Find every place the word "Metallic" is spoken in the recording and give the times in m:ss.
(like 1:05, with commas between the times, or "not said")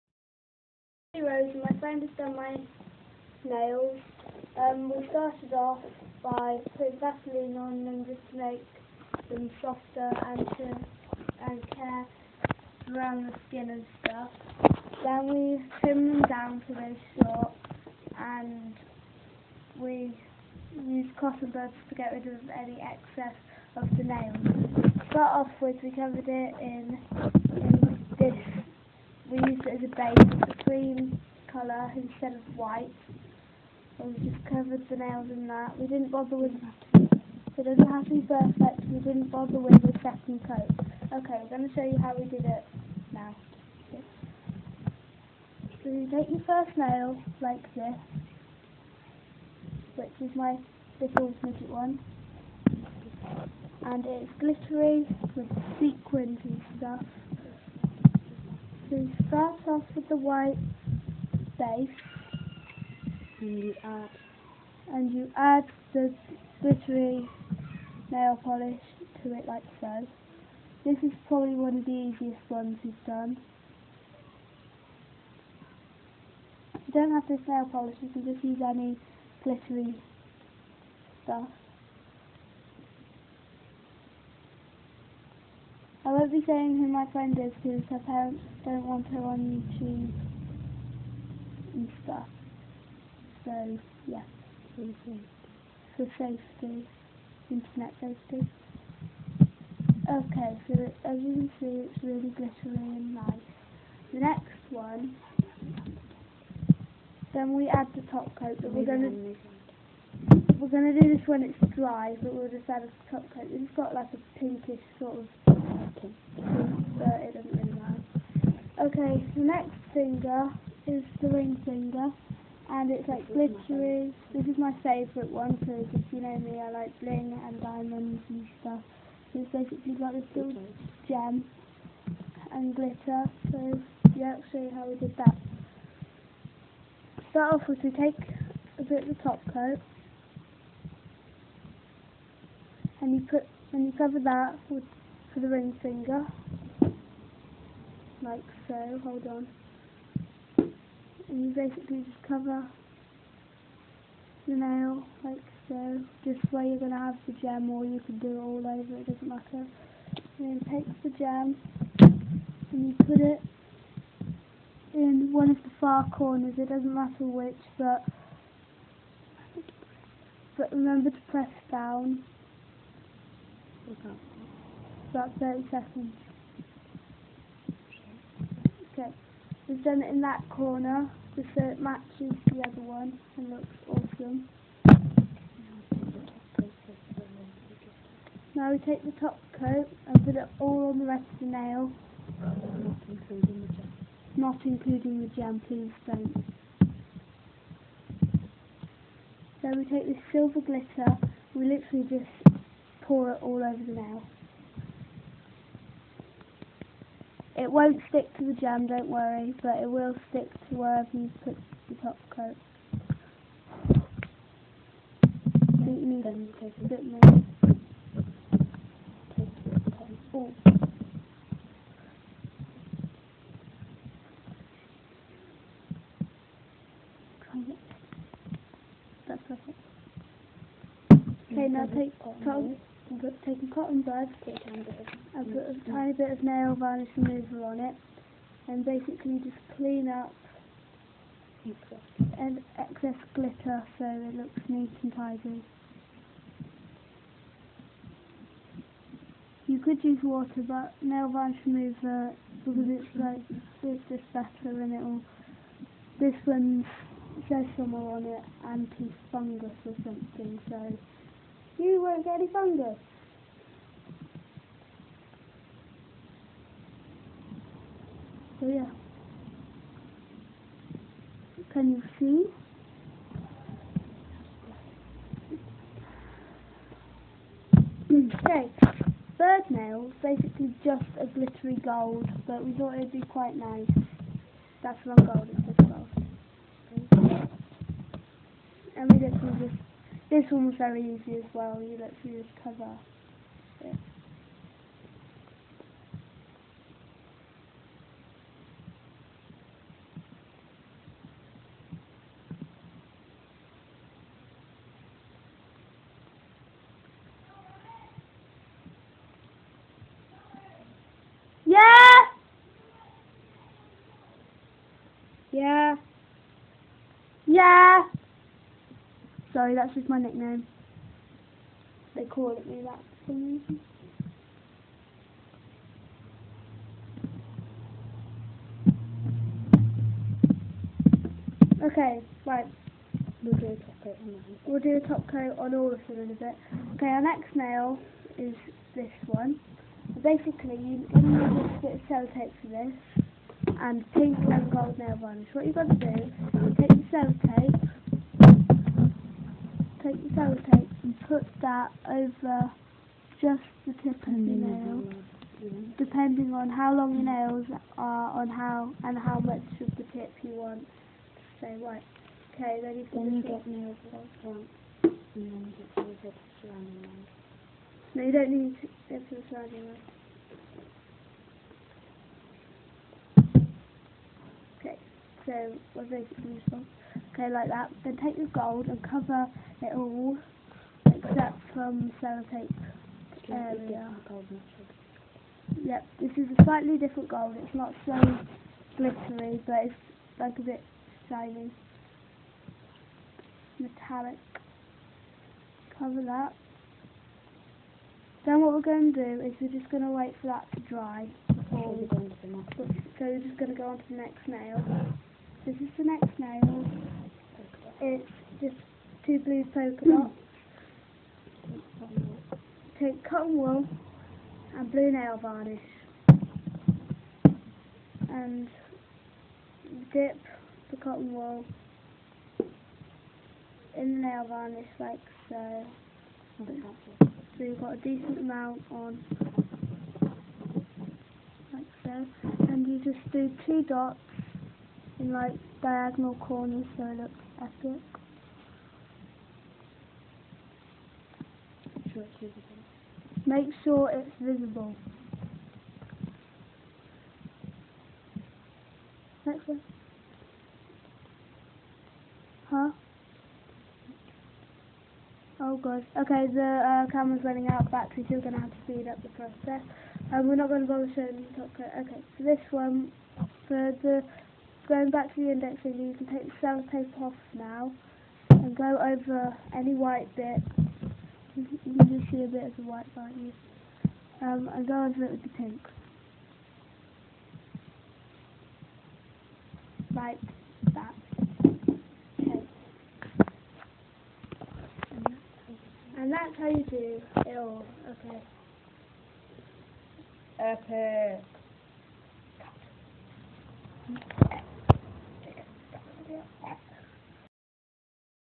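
6:33.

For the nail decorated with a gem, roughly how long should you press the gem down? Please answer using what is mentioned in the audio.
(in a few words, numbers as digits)
30 seconds.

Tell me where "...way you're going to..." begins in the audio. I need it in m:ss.
2:36.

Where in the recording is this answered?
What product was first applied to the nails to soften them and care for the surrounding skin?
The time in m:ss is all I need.
0:06.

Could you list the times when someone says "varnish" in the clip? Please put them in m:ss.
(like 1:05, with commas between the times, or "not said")
3:56, 4:11, 5:45, 6:55, 7:04.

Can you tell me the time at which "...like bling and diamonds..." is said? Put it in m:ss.
2:06.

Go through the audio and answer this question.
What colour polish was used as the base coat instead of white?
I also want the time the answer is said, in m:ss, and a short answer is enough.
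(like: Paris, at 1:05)
cream, at 0:30.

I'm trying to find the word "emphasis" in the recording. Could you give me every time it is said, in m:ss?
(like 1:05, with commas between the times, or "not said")
not said.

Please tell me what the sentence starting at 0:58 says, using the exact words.
So you start off with the white and you add and you add the glittery nail polish to it like so.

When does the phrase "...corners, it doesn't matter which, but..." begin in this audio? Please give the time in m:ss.
2:46.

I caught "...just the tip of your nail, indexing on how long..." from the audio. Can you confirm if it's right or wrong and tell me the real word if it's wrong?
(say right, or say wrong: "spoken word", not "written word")
wrong: "depending", not "indexing".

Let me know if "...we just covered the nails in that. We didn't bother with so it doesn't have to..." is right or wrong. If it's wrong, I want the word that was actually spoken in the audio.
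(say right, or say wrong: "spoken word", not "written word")
right.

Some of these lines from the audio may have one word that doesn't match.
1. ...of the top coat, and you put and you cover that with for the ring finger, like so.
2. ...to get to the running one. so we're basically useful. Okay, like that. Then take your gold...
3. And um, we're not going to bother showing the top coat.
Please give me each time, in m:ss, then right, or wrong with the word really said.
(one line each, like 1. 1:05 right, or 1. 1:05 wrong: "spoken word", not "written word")
1. 2:19 right
2. 6:08 wrong: "surrounding", not "running"
3. 7:40 right.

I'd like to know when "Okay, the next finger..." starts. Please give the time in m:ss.
1:58.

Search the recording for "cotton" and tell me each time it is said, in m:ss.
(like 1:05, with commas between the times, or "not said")
0:21, 3:53, 6:53, 7:00.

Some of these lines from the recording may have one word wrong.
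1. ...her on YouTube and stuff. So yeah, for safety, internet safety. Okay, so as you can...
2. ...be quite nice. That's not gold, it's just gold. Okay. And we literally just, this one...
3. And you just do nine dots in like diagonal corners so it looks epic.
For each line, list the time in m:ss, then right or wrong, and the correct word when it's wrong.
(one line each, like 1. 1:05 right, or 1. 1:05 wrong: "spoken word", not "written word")
1. 1:29 right
2. 4:43 right
3. 7:12 wrong: "two", not "nine".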